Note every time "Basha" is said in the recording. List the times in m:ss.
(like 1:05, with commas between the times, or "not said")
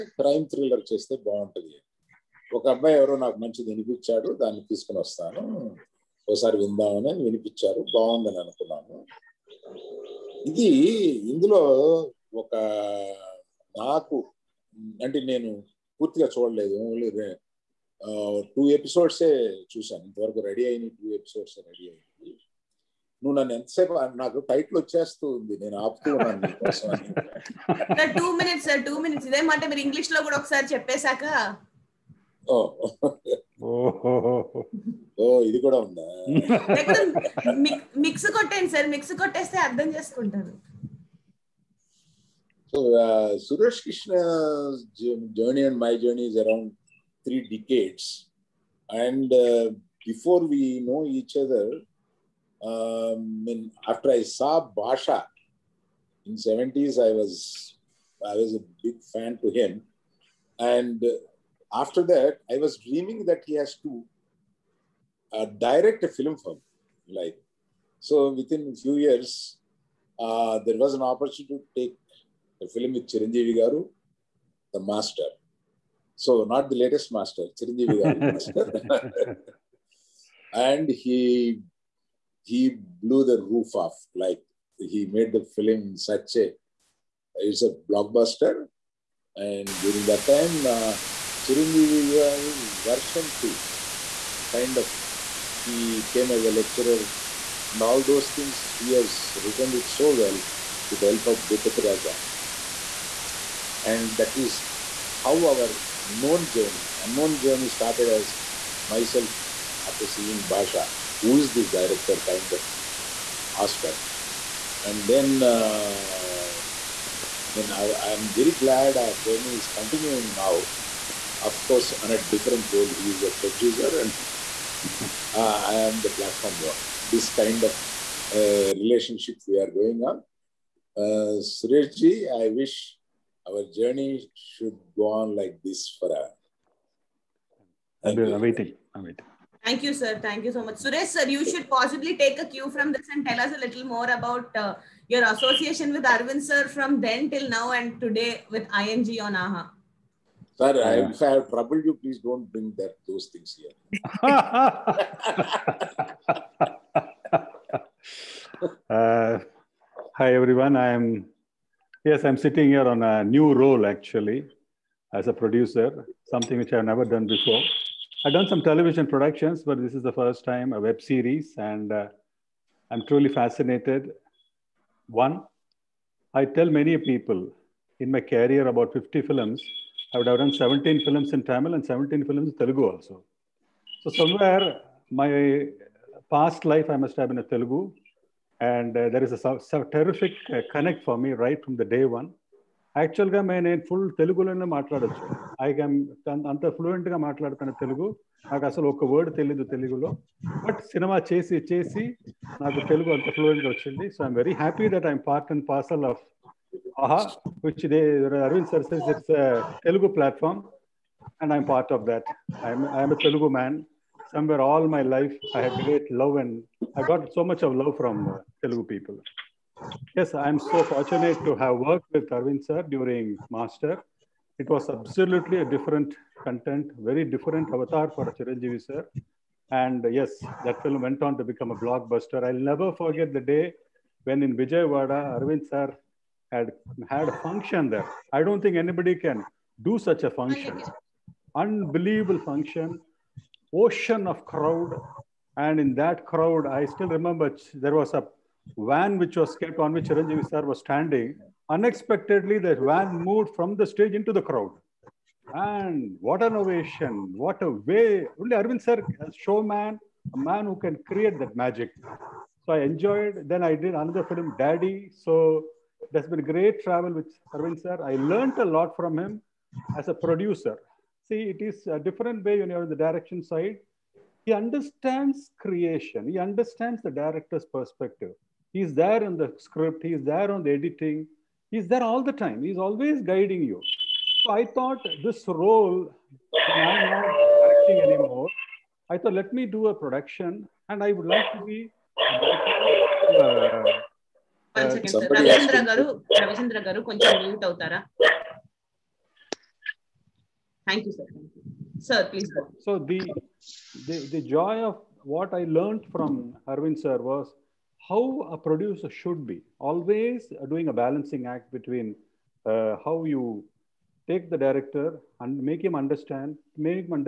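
0:54, 1:50.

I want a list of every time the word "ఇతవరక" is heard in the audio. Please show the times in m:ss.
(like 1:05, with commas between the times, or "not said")
0:20.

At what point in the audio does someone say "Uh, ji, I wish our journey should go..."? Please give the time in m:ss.
2:10.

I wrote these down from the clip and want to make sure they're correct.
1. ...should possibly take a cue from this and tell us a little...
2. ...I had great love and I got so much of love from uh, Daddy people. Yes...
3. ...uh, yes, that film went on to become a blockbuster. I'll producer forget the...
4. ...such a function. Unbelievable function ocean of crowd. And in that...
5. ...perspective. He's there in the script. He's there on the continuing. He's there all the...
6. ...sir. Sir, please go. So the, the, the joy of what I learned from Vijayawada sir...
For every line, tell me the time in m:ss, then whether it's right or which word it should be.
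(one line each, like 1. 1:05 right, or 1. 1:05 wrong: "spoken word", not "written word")
1. 2:21 right
2. 3:35 wrong: "Telugu", not "Daddy"
3. 3:50 wrong: "never", not "producer"
4. 4:00 right
5. 4:37 wrong: "editing", not "continuing"
6. 5:01 wrong: "Arvind", not "Vijayawada".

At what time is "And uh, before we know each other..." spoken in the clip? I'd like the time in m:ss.
0:48.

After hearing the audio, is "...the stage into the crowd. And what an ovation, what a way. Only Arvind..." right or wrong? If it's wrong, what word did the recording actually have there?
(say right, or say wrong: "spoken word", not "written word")
right.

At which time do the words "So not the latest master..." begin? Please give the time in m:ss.
1:16.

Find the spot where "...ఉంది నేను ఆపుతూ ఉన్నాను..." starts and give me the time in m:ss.
0:25.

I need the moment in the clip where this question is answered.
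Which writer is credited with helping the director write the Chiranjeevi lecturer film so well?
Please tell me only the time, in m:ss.
1:41.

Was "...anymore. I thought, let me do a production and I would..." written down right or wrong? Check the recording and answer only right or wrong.
right.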